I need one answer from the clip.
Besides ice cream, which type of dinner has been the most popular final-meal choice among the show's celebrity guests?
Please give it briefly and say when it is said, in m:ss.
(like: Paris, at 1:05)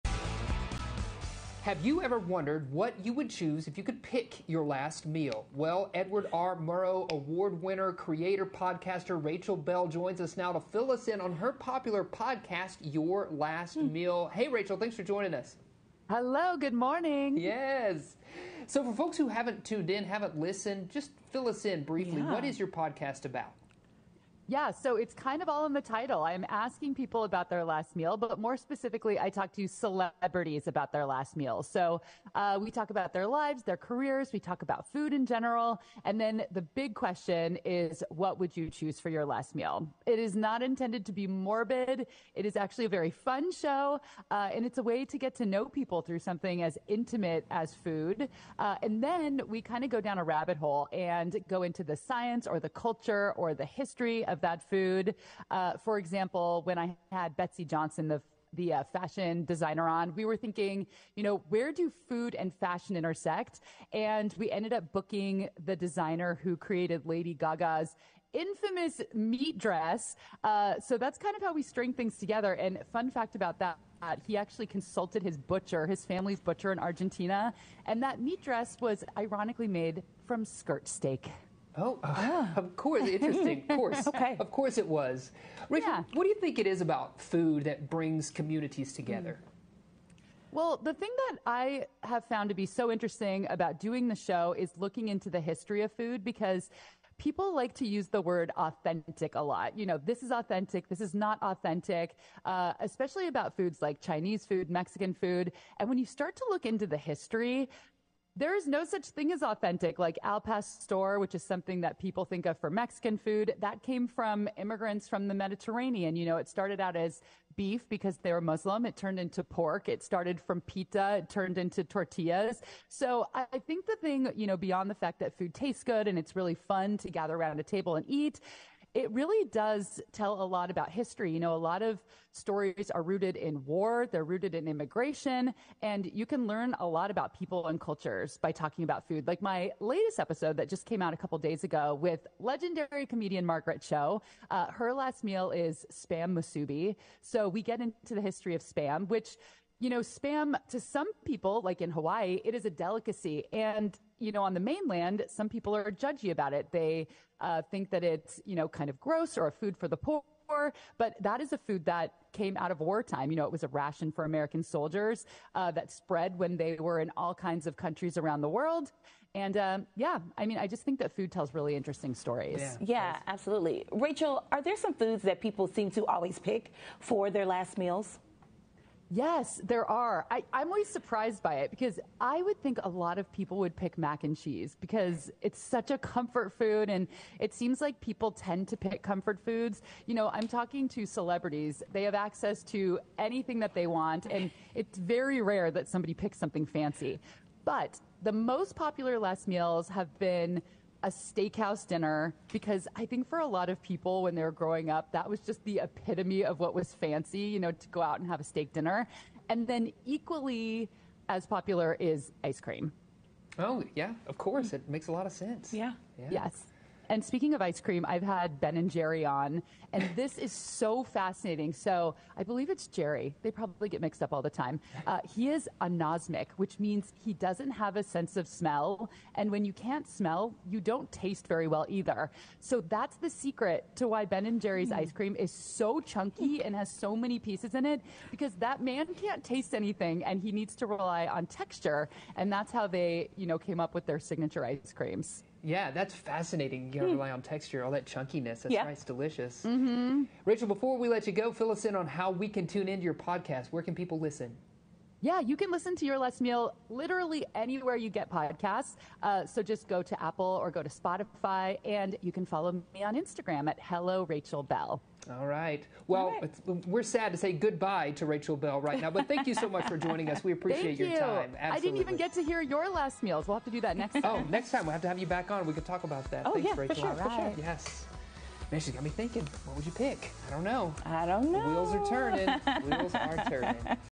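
steakhouse dinner, at 3:21.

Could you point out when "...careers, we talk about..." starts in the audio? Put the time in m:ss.
0:33.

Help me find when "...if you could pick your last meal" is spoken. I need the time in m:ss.
0:03.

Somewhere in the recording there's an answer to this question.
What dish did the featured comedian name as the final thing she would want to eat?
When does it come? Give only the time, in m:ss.
2:25.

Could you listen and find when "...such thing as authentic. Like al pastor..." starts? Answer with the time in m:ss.
1:48.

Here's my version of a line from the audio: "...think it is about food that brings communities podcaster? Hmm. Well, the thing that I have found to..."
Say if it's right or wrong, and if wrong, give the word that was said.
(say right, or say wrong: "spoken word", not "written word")
wrong: "together", not "podcaster".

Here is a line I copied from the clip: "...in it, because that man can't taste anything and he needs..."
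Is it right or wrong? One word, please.
right.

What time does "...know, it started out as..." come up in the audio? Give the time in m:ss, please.
1:56.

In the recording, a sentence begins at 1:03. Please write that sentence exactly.
And we ended up booking the designer who created Lady Gaga's infamous meat dress.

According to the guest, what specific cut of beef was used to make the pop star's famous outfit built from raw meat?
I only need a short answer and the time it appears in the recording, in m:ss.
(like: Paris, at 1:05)
skirt steak, at 1:20.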